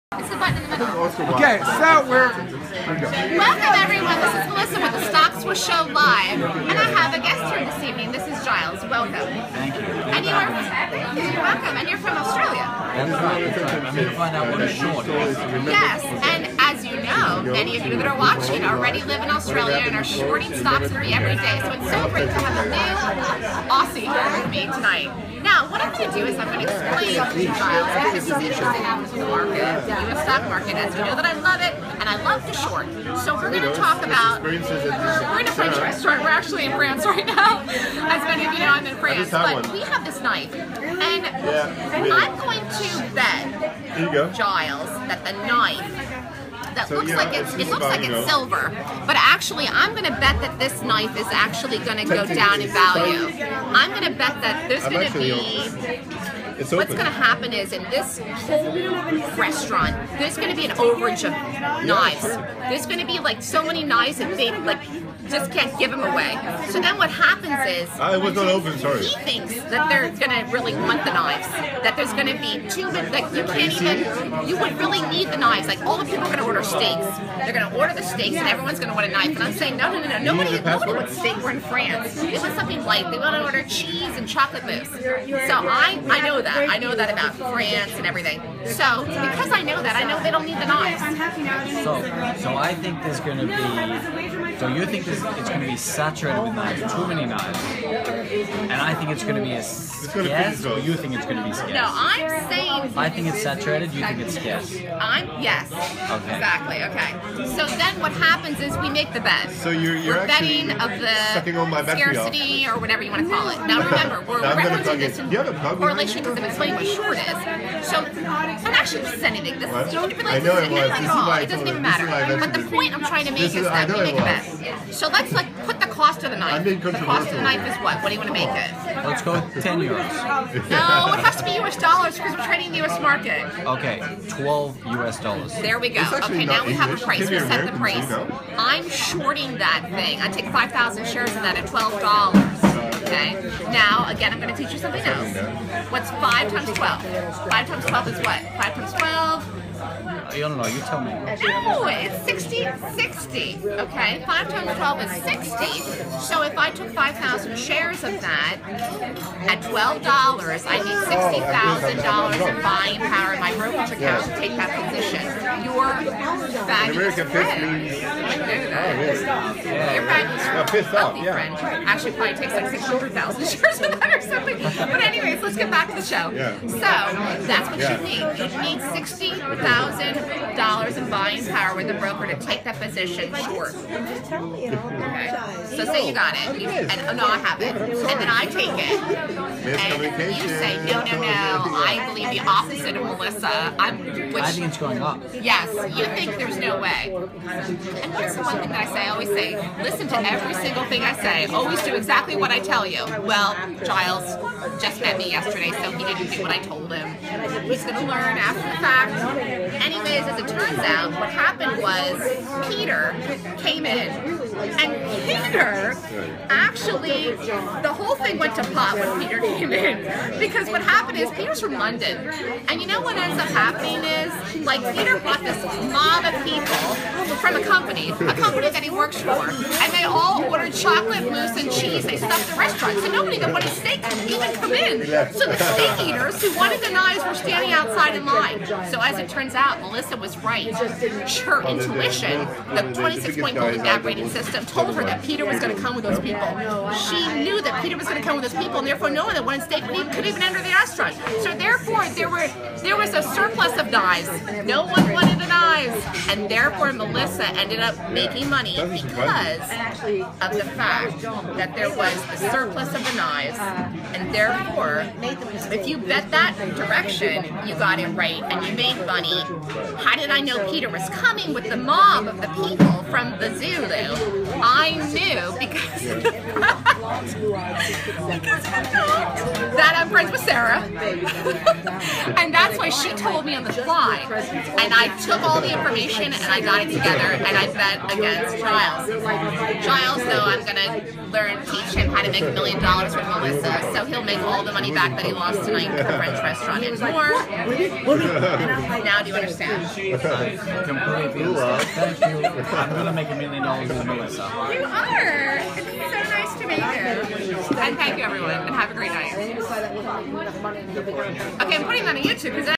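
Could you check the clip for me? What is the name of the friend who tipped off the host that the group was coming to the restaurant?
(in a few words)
Sarah.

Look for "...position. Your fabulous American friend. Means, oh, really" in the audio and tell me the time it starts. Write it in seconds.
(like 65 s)
164 s.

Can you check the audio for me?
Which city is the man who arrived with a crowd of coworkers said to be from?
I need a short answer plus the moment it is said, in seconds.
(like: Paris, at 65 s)
London, at 221 s.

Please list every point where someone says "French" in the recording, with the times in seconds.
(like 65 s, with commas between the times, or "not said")
35 s, 296 s.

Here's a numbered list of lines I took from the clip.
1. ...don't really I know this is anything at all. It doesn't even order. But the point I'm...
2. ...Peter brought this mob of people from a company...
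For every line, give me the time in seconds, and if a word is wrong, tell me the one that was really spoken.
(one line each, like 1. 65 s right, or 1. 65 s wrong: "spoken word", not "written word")
1. 119 s wrong: "matter", not "order"
2. 224 s right.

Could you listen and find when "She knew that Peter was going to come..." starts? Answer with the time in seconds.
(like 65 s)
246 s.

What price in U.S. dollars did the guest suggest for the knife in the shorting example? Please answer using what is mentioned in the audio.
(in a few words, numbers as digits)
$12.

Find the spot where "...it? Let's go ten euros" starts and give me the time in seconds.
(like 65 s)
128 s.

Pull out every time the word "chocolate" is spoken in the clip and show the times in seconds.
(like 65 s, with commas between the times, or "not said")
84 s, 230 s.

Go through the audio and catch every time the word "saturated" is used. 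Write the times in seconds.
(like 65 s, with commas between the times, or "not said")
95 s, 103 s.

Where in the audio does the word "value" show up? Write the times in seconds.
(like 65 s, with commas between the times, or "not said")
52 s.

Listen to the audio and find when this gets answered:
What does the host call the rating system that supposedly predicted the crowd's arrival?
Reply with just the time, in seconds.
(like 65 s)
242 s.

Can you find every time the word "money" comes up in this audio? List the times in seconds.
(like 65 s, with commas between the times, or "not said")
258 s, 269 s, 294 s.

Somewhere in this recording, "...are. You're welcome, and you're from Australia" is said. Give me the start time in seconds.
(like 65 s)
10 s.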